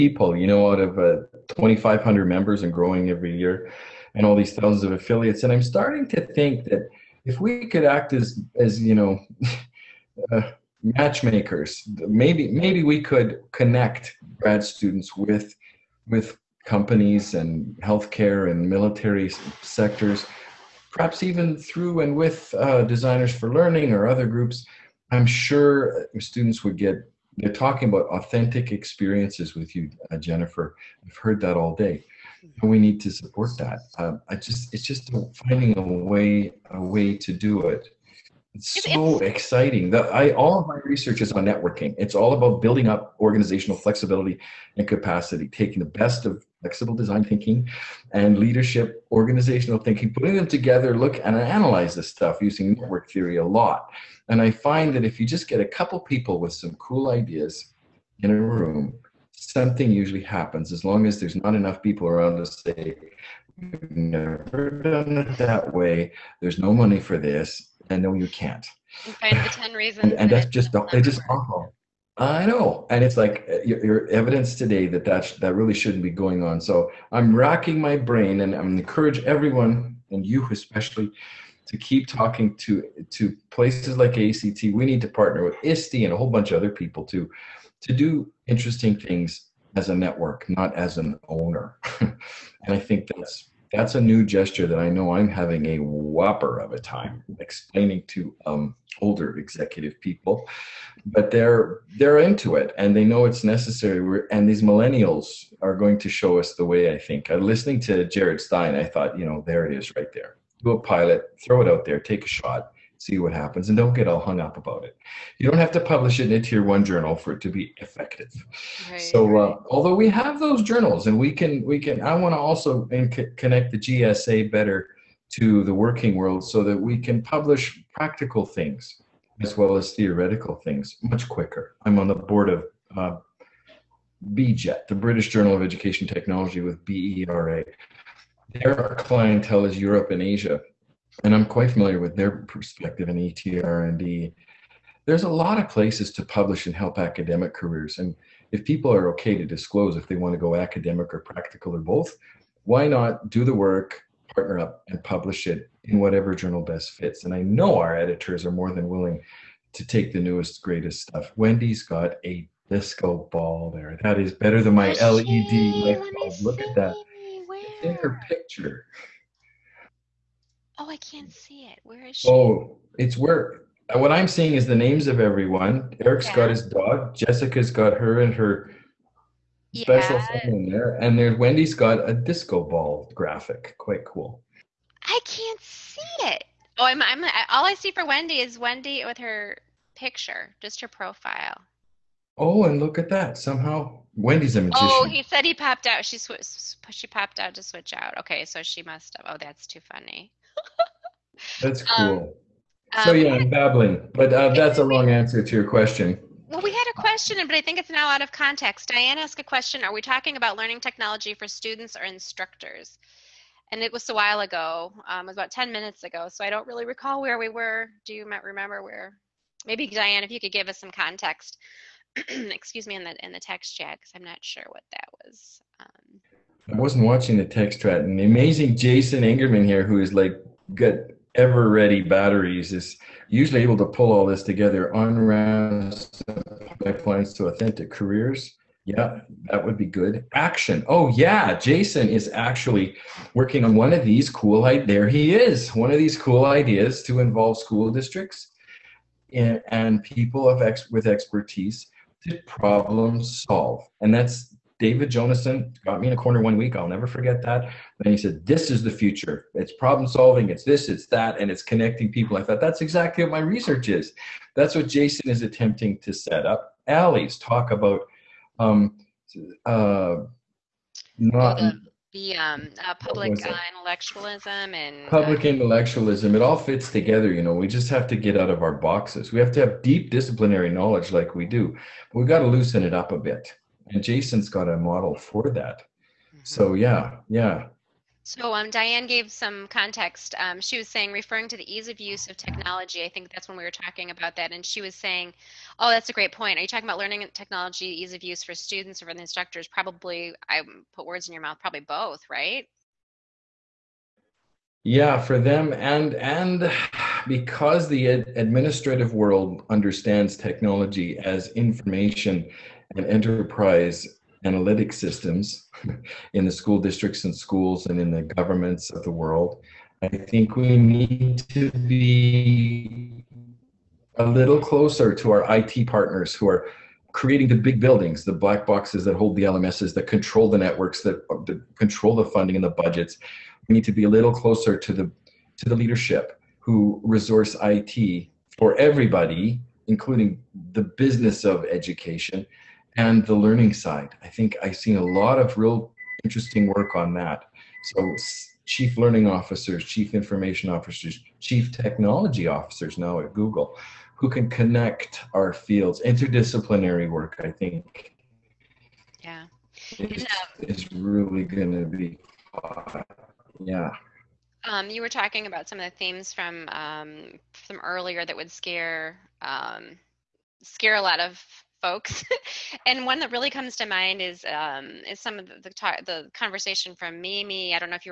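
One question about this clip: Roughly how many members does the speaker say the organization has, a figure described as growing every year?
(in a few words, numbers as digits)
2,500.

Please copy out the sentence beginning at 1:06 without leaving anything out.
There's no money for this I know you can't.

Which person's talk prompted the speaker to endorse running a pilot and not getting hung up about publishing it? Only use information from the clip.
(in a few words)
Jared Stein.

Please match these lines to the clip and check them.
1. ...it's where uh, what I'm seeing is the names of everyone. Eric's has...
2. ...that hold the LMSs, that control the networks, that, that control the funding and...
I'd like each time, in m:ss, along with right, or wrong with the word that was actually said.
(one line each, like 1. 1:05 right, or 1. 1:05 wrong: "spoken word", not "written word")
1. 2:52 right
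2. 5:29 right.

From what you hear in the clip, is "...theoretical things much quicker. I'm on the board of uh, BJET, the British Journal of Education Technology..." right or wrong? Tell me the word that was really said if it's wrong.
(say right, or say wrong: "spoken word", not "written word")
right.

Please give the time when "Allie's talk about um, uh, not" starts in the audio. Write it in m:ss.
4:26.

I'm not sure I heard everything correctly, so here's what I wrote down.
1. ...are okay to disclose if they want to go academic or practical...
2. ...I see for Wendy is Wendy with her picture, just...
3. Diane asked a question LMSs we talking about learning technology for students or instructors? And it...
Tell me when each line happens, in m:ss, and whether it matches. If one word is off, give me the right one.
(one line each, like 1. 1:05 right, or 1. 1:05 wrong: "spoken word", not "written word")
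1. 2:28 right
2. 3:07 right
3. 3:28 wrong: "Are", not "LMSs".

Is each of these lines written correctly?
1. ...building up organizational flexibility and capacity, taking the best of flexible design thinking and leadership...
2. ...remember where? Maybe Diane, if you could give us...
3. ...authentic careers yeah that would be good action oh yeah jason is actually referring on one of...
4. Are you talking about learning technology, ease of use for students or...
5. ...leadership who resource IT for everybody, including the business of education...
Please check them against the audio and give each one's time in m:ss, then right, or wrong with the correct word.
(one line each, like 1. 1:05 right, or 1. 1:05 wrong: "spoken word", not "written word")
1. 0:42 right
2. 3:38 right
3. 3:57 wrong: "working", not "referring"
4. 4:56 right
5. 5:35 right.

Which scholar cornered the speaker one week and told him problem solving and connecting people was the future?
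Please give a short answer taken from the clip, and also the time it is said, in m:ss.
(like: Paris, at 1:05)
David Jonassen, at 4:14.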